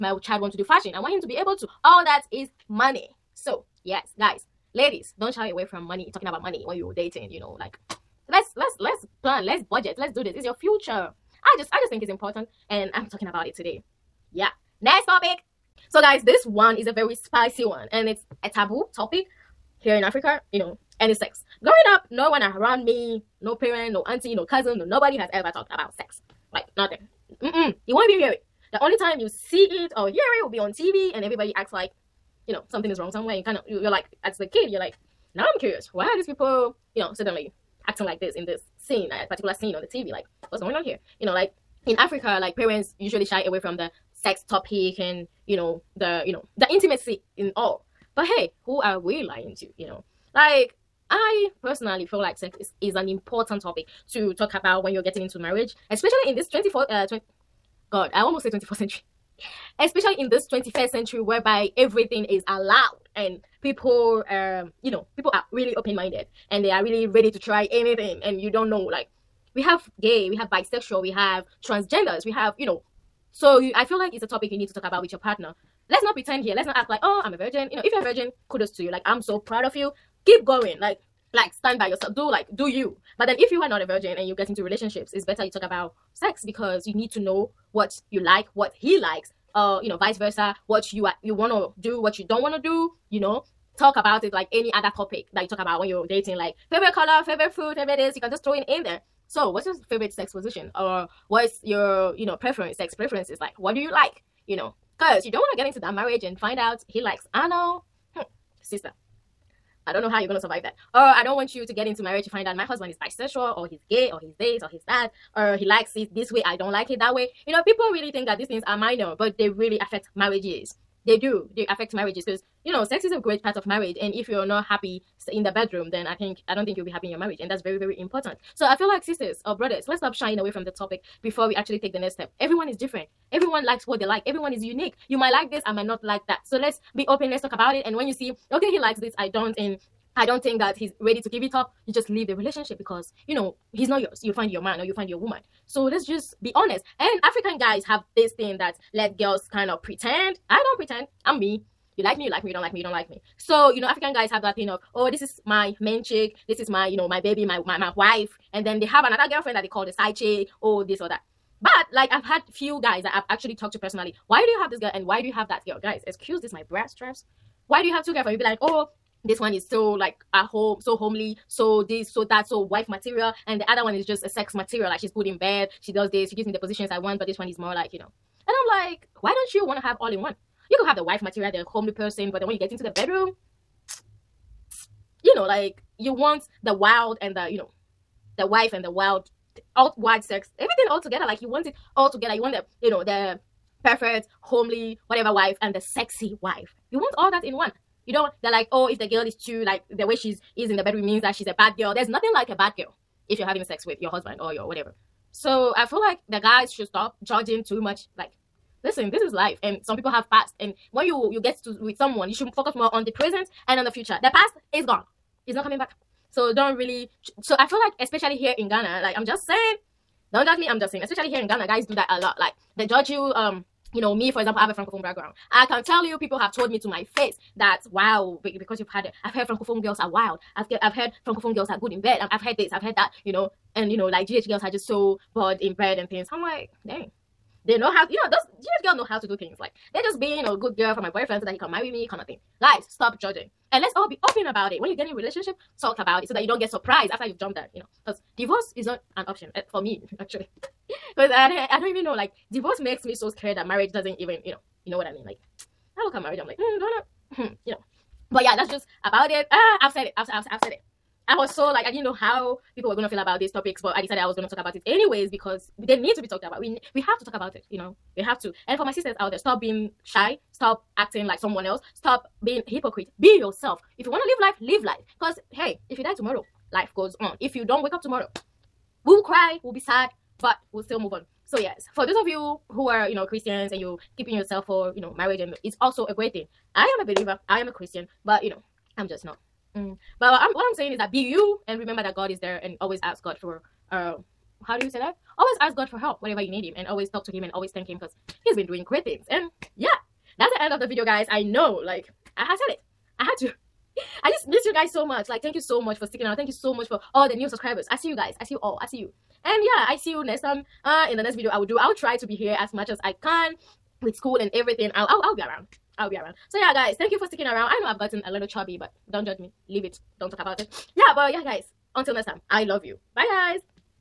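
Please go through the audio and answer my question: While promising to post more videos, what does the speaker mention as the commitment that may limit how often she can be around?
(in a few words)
school.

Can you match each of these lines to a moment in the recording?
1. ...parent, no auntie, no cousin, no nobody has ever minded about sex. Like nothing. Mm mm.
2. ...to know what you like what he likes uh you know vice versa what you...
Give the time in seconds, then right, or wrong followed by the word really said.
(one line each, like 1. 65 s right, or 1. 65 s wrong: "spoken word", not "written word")
1. 23 s wrong: "talked", not "minded"
2. 87 s right.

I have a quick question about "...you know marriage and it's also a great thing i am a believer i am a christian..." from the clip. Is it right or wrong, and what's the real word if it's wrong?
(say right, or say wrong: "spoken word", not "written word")
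right.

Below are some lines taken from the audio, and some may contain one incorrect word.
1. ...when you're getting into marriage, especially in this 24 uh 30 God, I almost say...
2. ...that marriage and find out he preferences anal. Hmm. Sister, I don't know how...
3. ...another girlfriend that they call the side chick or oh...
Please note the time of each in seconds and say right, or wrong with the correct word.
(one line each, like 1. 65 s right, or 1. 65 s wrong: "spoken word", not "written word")
1. 54 s wrong: "20", not "30"
2. 105 s wrong: "likes", not "preferences"
3. 159 s right.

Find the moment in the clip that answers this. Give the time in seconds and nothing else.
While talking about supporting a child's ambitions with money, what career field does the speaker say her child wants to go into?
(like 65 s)
0 s.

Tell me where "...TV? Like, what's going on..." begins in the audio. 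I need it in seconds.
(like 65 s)
39 s.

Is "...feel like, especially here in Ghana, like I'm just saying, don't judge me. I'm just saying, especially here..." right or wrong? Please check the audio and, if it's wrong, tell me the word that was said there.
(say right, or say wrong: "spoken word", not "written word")
right.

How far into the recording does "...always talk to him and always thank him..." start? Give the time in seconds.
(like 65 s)
296 s.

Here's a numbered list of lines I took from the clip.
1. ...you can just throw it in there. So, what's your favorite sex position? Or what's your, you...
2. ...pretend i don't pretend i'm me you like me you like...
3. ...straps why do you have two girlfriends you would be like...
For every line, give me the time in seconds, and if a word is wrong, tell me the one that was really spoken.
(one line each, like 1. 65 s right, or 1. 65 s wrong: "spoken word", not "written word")
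1. 98 s right
2. 149 s right
3. 166 s right.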